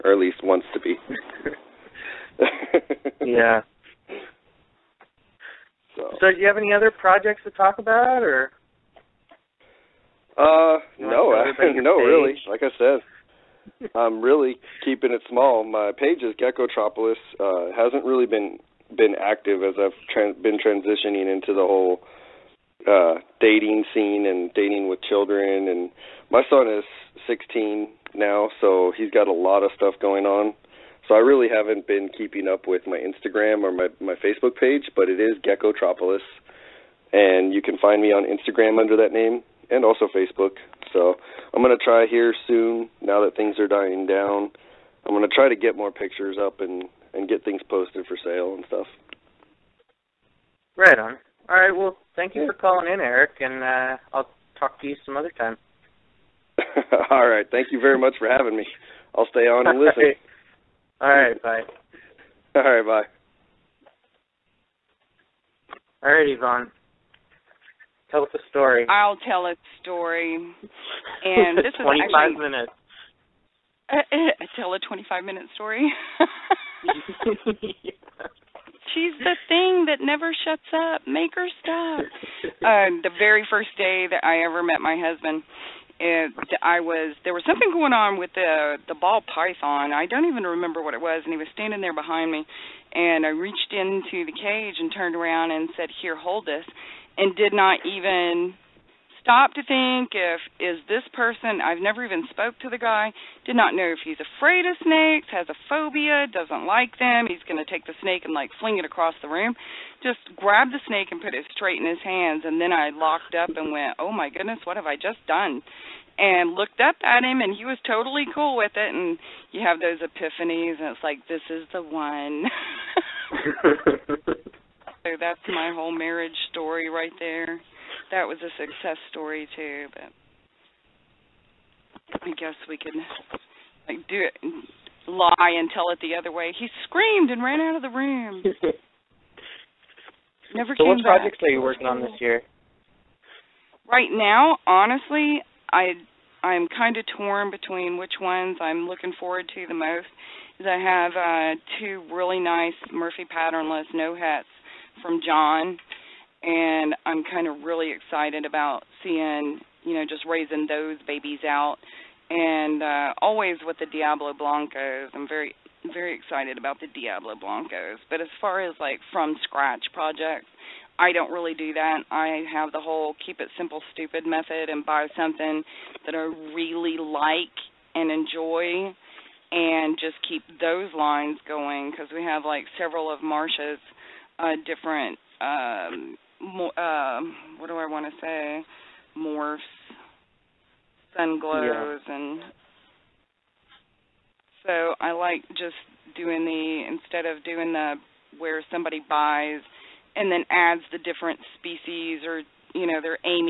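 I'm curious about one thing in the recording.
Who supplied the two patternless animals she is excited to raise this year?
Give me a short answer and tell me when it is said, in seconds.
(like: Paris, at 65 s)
John, at 155 s.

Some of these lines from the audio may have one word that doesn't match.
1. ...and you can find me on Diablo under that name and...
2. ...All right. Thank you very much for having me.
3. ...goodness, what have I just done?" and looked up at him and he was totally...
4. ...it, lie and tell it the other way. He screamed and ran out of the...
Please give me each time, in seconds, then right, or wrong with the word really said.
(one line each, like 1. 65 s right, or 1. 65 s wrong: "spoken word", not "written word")
1. 37 s wrong: "Instagram", not "Diablo"
2. 57 s right
3. 114 s right
4. 134 s right.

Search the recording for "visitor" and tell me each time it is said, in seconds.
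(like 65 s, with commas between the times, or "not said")
not said.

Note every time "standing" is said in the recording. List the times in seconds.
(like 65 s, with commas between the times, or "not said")
91 s.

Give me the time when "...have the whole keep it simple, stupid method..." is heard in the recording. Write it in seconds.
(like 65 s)
172 s.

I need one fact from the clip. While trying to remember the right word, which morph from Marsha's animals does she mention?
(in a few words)
sun glows.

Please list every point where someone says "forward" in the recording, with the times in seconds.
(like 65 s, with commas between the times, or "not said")
149 s.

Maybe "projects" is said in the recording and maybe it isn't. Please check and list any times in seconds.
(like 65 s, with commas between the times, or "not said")
6 s, 141 s, 169 s.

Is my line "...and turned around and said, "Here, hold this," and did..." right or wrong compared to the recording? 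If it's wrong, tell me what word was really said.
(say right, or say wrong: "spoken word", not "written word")
right.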